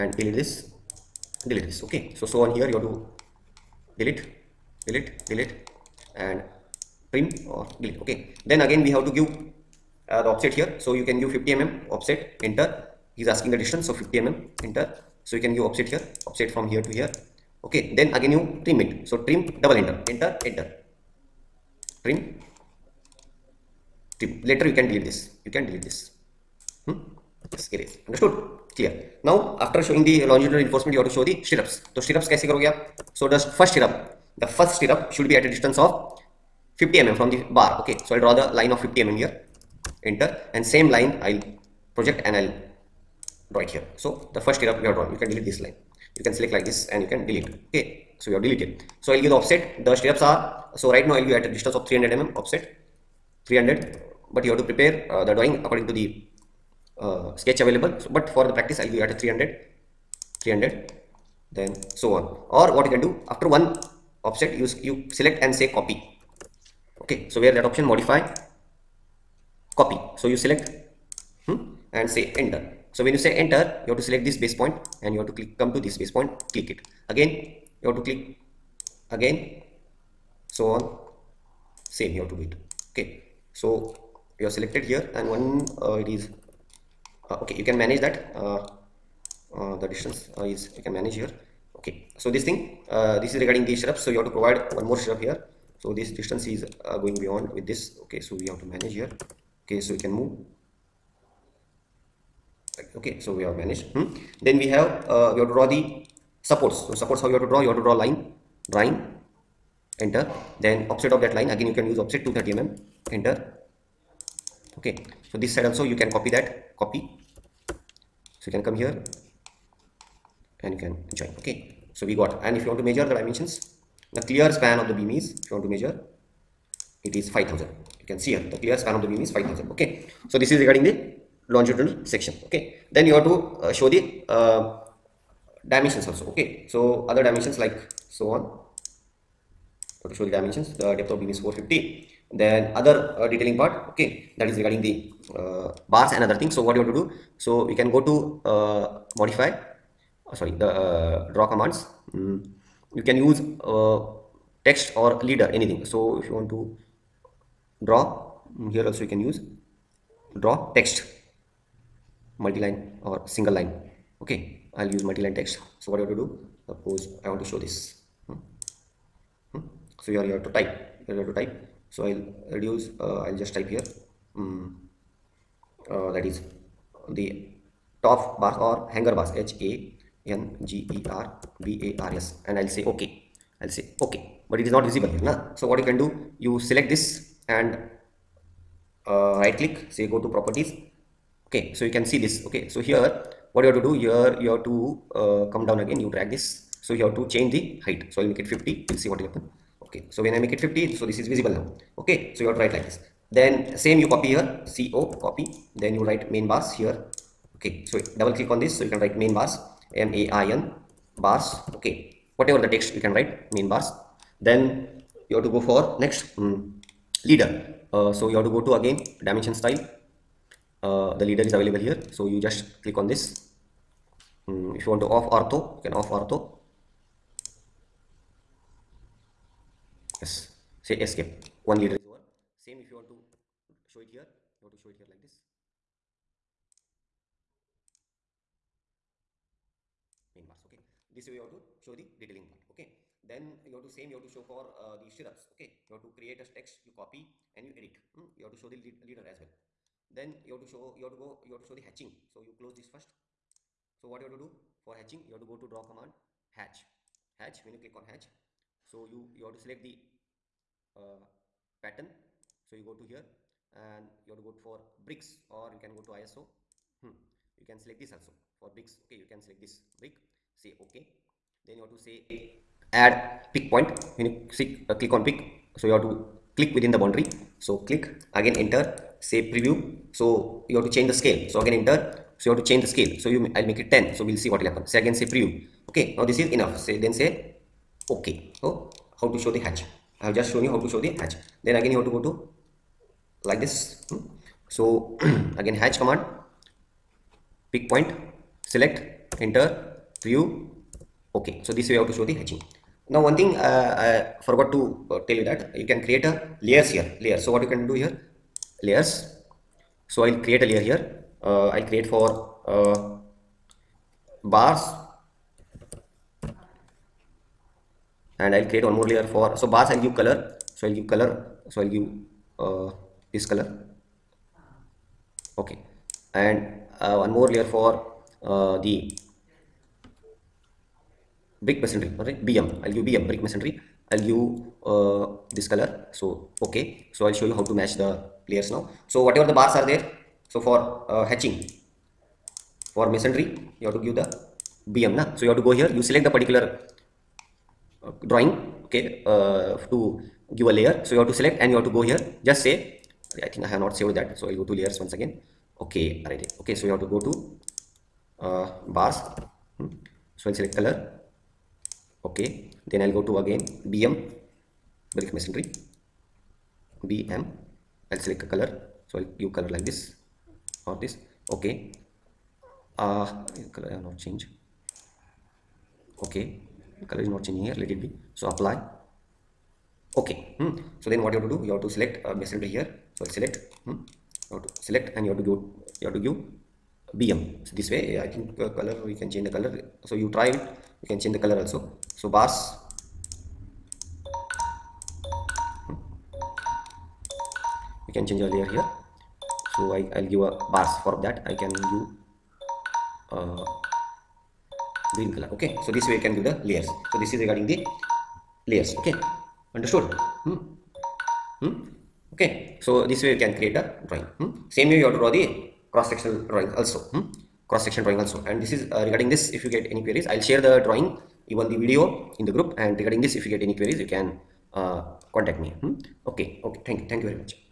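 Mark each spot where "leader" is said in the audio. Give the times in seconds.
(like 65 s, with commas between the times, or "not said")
155 s, 217 s, 221 s, 231 s, 249 s.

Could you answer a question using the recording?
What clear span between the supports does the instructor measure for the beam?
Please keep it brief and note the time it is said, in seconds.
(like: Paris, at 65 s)
5000, at 127 s.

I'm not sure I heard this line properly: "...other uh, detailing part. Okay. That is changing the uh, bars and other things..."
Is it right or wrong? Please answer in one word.
wrong.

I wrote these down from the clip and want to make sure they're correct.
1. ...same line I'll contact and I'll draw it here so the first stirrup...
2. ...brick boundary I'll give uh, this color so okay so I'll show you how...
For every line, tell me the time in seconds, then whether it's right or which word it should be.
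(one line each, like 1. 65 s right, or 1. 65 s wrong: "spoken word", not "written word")
1. 40 s wrong: "project", not "contact"
2. 333 s wrong: "masonry", not "boundary".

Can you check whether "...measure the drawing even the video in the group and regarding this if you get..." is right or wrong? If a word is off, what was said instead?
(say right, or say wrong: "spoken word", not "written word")
wrong: "share", not "measure".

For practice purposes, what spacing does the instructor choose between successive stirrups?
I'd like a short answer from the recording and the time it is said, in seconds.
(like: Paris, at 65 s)
300 mm, at 51 s.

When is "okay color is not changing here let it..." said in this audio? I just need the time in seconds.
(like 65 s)
376 s.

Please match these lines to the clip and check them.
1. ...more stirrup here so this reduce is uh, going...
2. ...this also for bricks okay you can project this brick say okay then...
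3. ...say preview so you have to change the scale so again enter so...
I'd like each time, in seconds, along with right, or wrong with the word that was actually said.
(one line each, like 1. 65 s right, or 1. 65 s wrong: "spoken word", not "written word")
1. 94 s wrong: "distance", not "reduce"
2. 267 s wrong: "select", not "project"
3. 279 s right.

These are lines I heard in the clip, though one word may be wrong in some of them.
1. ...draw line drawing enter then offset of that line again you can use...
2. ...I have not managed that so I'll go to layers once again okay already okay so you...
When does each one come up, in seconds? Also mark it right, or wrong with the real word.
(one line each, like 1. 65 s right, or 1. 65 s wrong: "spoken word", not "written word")
1. 107 s right
2. 353 s wrong: "saved", not "managed".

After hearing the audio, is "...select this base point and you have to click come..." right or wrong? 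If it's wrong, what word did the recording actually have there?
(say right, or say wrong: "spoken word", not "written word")
right.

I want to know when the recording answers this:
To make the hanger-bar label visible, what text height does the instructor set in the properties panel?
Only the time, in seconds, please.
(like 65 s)
198 s.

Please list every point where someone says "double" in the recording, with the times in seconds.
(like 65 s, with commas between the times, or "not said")
19 s, 208 s.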